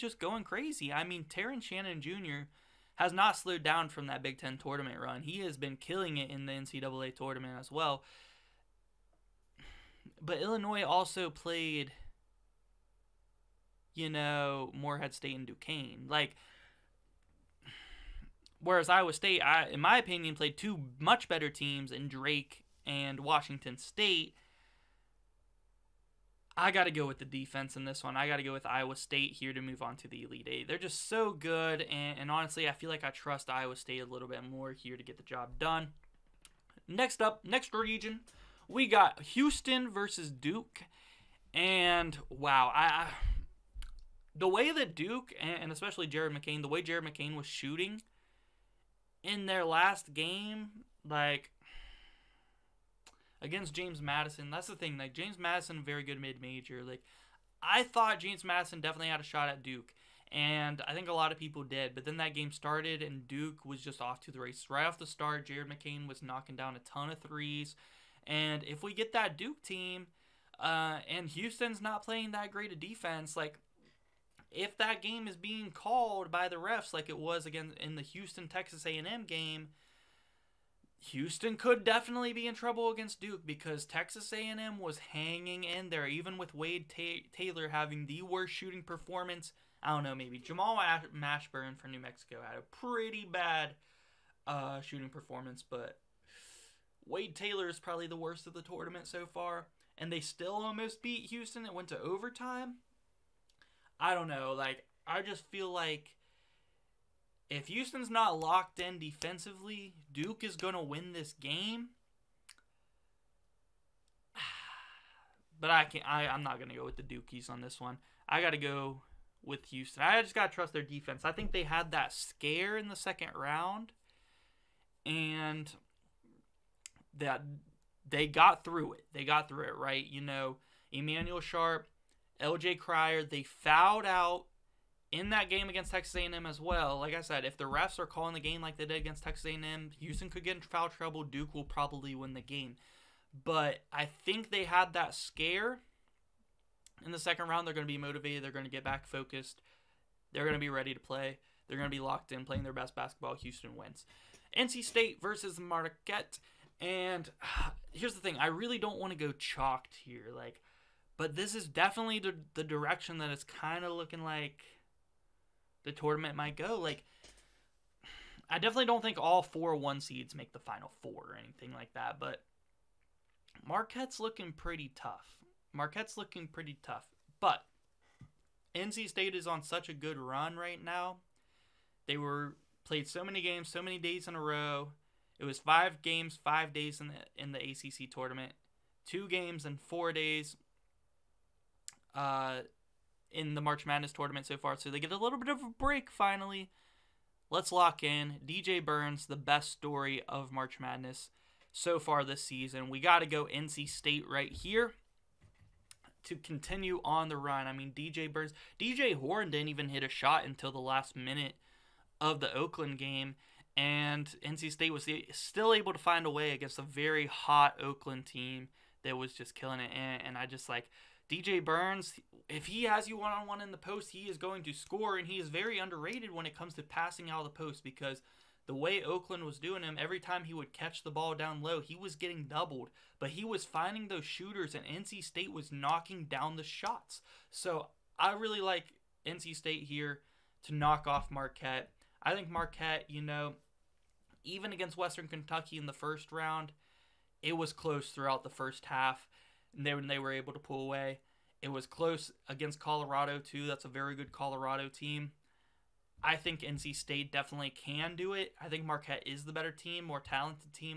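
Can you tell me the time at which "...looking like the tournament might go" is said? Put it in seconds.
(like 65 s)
163 s.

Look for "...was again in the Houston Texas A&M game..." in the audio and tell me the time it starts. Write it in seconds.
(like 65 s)
77 s.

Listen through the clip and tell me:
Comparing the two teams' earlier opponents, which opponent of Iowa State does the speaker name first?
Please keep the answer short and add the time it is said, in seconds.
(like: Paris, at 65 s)
Drake, at 22 s.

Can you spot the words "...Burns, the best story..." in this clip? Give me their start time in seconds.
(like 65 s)
198 s.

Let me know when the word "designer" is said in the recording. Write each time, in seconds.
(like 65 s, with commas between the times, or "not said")
not said.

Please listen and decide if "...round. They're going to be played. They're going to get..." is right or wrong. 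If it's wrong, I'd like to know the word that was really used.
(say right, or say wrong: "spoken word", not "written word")
wrong: "motivated", not "played".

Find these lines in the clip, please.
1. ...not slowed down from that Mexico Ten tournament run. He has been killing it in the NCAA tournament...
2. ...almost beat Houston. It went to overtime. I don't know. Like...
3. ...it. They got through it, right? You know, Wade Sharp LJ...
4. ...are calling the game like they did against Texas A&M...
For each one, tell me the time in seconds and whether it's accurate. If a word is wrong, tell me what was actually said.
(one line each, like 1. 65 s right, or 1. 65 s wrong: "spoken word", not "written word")
1. 3 s wrong: "Big", not "Mexico"
2. 100 s right
3. 128 s wrong: "Emanuel", not "Wade"
4. 137 s right.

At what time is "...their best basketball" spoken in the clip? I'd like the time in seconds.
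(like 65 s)
152 s.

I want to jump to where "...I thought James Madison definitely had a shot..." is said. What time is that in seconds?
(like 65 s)
57 s.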